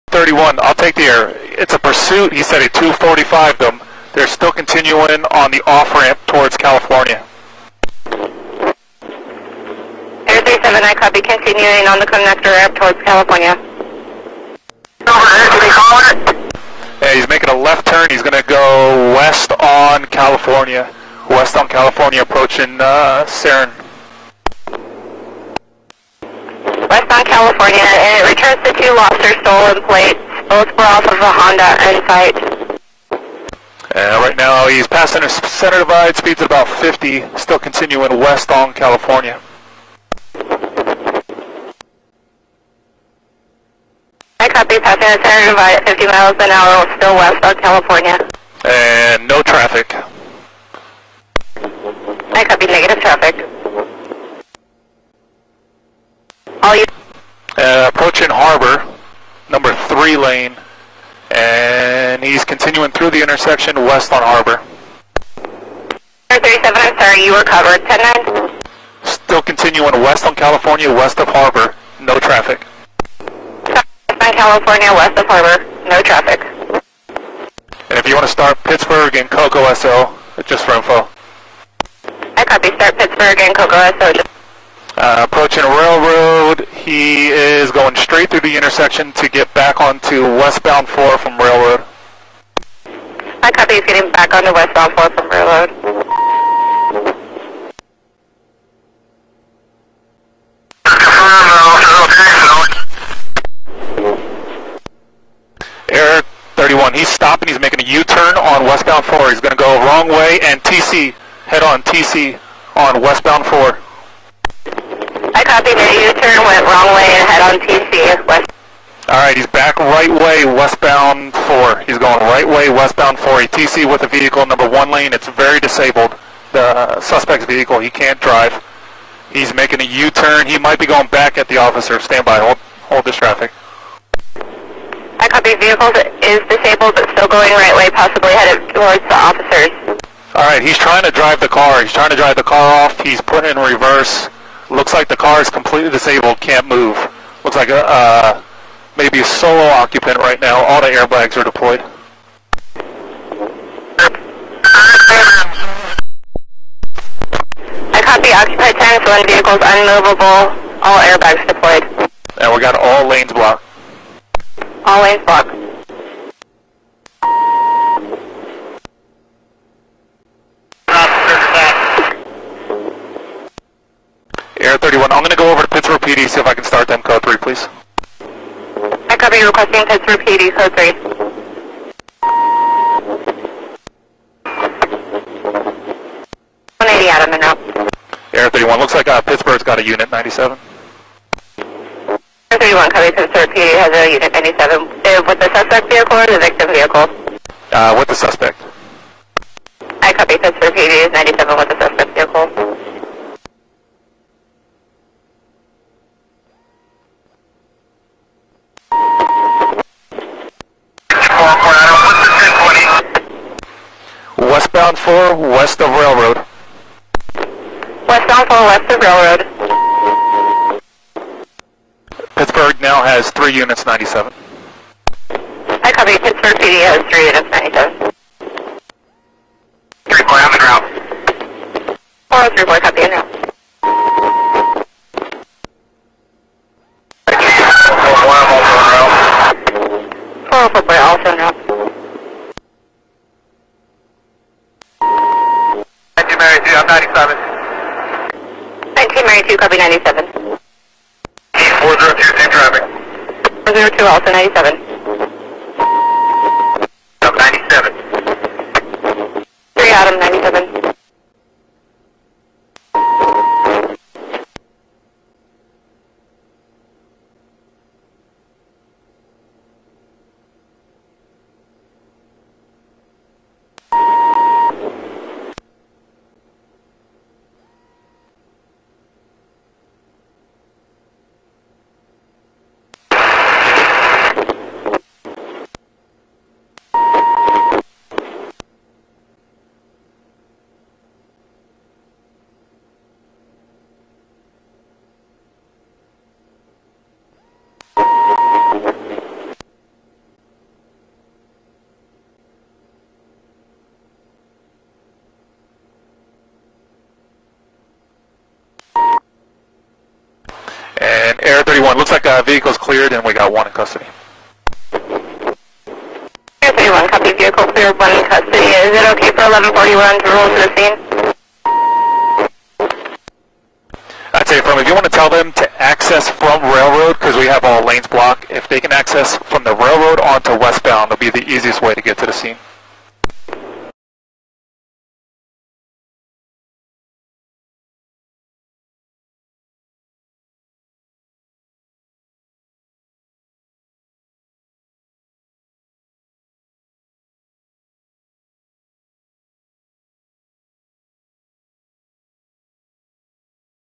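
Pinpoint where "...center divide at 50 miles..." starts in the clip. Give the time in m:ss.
0:45.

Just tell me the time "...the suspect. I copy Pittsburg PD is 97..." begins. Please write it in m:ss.
3:18.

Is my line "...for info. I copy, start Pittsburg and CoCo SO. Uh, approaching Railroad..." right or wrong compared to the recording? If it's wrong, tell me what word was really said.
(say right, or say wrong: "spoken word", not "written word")
right.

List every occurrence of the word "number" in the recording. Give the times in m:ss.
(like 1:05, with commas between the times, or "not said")
0:59, 2:04.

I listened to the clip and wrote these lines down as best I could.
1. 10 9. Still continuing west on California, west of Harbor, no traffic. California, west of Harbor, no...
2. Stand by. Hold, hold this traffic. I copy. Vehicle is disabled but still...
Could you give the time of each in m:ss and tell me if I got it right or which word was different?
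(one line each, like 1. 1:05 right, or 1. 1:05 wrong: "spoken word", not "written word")
1. 1:07 right
2. 2:11 right.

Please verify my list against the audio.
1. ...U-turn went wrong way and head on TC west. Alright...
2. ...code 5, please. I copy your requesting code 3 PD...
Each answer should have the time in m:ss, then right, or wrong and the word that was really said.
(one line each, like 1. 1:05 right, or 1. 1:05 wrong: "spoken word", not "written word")
1. 1:56 right
2. 2:57 wrong: "3", not "5".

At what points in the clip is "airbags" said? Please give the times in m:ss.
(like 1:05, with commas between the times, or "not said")
2:30, 2:41.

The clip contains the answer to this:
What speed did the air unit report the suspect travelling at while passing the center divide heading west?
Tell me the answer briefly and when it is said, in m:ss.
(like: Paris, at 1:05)
50, at 0:36.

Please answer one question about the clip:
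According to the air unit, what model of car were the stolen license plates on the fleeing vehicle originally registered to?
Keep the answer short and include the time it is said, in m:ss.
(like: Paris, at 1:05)
Honda Insight, at 0:31.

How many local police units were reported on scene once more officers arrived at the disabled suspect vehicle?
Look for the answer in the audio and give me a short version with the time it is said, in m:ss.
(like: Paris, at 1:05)
3, at 3:42.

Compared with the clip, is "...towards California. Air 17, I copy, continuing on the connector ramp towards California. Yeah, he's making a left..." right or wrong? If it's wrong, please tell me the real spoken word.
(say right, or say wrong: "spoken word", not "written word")
wrong: "37", not "17".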